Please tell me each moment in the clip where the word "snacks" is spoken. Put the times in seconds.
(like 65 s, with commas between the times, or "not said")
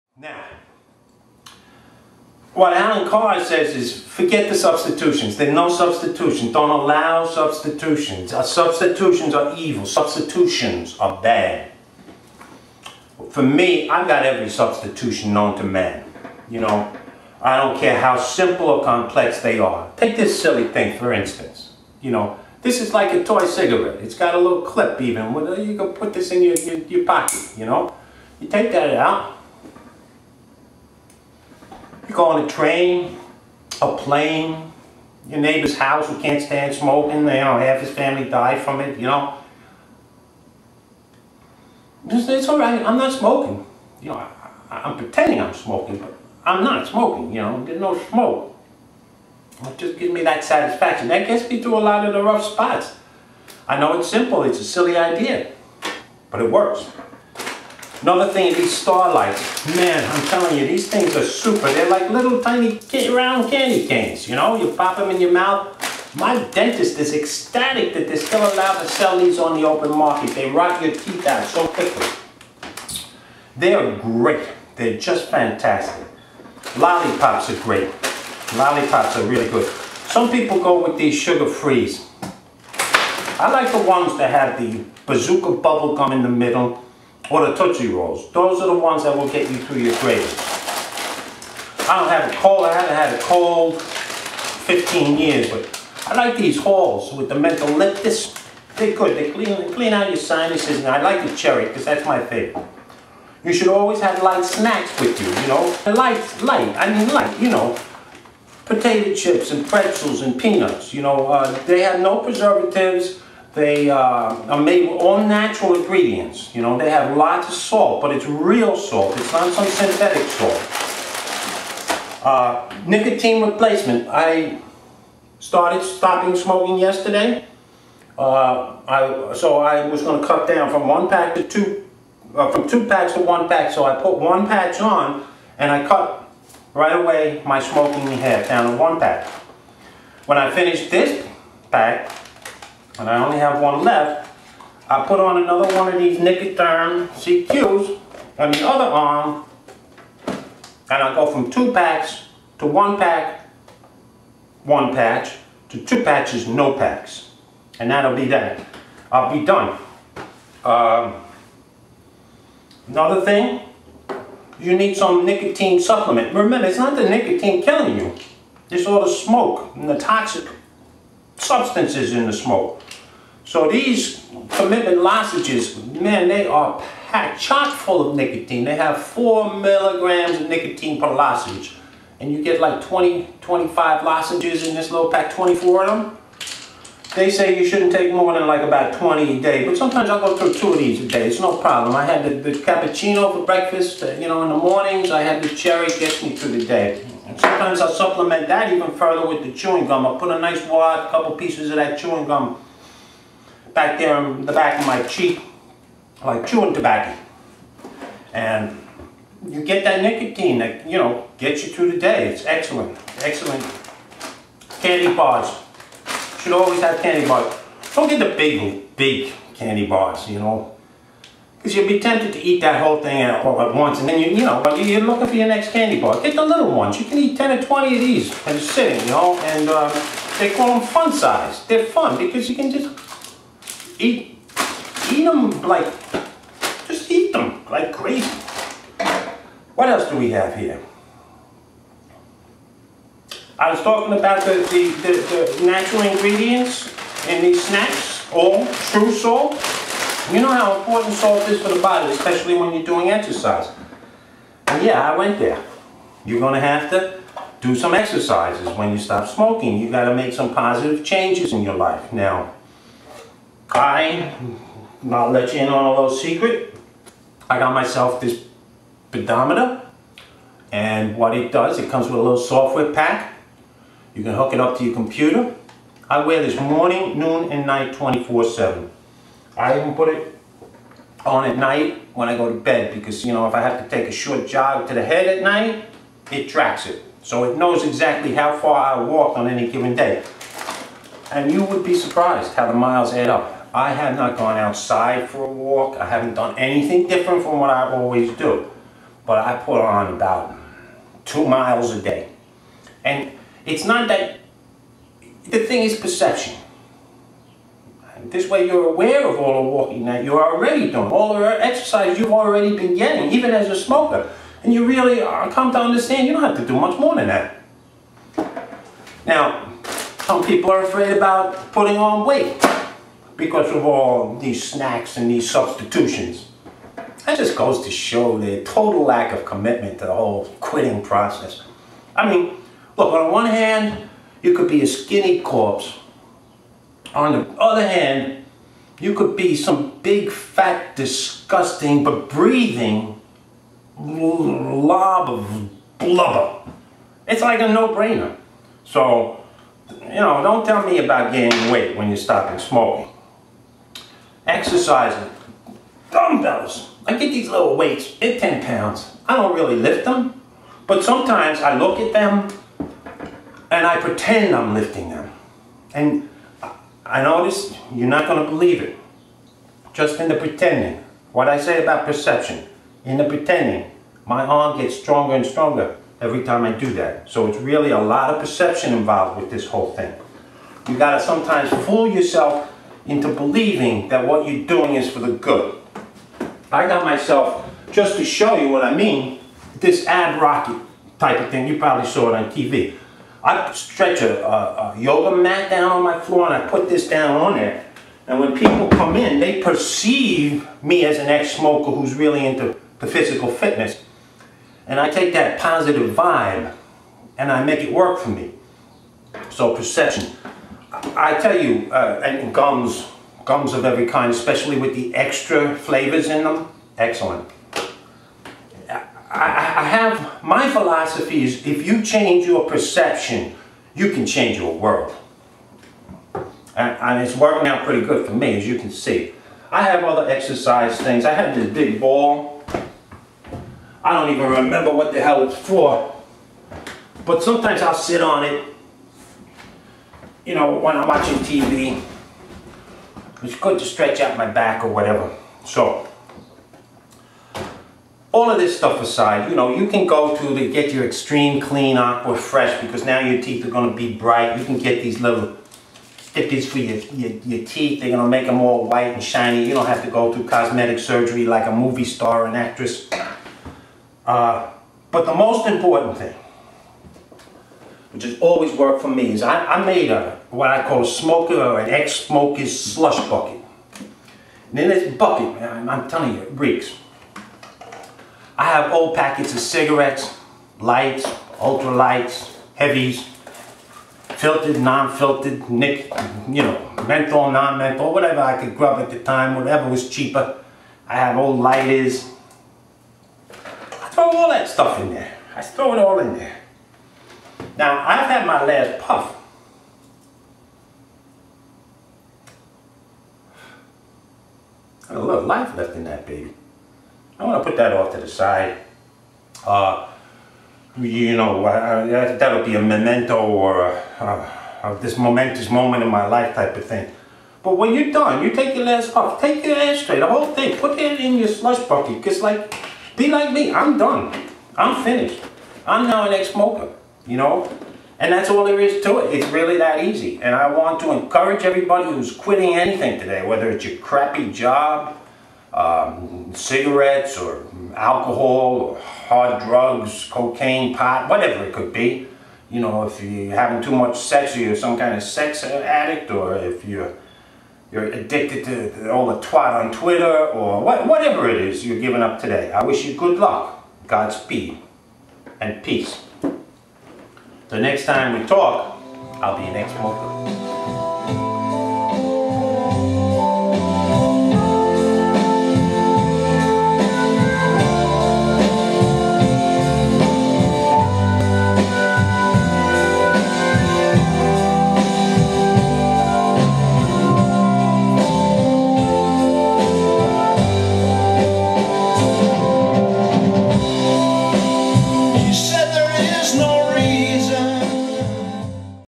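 104 s, 247 s, 324 s.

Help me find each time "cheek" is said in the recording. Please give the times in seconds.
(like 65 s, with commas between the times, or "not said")
205 s.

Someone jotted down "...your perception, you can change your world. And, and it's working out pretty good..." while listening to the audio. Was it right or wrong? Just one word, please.
right.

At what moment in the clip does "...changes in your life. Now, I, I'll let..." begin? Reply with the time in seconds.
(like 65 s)
261 s.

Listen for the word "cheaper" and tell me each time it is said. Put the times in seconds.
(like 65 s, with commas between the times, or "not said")
490 s.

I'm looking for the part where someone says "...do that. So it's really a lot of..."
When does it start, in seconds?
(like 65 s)
376 s.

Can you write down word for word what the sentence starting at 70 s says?
They rot your teeth out so quickly.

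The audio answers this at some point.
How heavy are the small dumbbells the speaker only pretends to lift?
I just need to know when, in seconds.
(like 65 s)
358 s.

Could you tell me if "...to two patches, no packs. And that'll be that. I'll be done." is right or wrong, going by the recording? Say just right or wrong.
right.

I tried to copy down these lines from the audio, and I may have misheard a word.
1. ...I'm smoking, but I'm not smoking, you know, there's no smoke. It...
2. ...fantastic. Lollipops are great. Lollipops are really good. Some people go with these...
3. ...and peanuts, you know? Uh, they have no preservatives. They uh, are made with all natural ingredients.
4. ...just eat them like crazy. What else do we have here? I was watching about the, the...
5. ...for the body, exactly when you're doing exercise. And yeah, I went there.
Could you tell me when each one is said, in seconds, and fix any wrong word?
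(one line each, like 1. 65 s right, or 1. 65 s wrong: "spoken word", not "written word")
1. 45 s right
2. 75 s right
3. 110 s right
4. 236 s wrong: "talking", not "watching"
5. 251 s wrong: "especially", not "exactly".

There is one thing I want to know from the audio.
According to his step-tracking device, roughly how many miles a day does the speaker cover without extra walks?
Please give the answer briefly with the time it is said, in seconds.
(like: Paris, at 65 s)
2, at 301 s.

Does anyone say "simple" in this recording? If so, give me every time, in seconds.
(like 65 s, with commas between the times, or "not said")
18 s, 54 s.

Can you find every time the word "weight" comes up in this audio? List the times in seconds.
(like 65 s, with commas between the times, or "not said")
322 s, 351 s, 357 s.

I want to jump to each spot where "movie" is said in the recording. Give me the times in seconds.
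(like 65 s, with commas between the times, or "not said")
461 s.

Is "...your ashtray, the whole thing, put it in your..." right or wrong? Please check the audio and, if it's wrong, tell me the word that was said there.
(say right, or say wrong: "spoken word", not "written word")
right.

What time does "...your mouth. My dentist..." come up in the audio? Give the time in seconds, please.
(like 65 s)
65 s.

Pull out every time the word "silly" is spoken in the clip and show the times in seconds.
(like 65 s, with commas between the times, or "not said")
20 s, 54 s.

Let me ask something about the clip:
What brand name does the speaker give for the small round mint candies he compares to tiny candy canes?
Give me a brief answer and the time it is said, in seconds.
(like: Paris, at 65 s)
Starlights, at 58 s.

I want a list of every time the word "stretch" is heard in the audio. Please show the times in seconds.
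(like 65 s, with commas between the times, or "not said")
393 s, 443 s.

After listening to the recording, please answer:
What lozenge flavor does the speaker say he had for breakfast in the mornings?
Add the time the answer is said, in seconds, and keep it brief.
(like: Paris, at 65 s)
Cappuccino, at 192 s.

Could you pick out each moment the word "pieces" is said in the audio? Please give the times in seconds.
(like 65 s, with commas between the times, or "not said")
201 s.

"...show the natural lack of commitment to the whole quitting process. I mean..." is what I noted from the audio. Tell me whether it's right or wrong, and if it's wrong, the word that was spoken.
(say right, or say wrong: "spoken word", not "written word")
wrong: "total", not "natural".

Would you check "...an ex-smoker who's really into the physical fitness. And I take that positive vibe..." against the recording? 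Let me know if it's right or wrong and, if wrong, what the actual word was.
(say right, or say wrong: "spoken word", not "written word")
right.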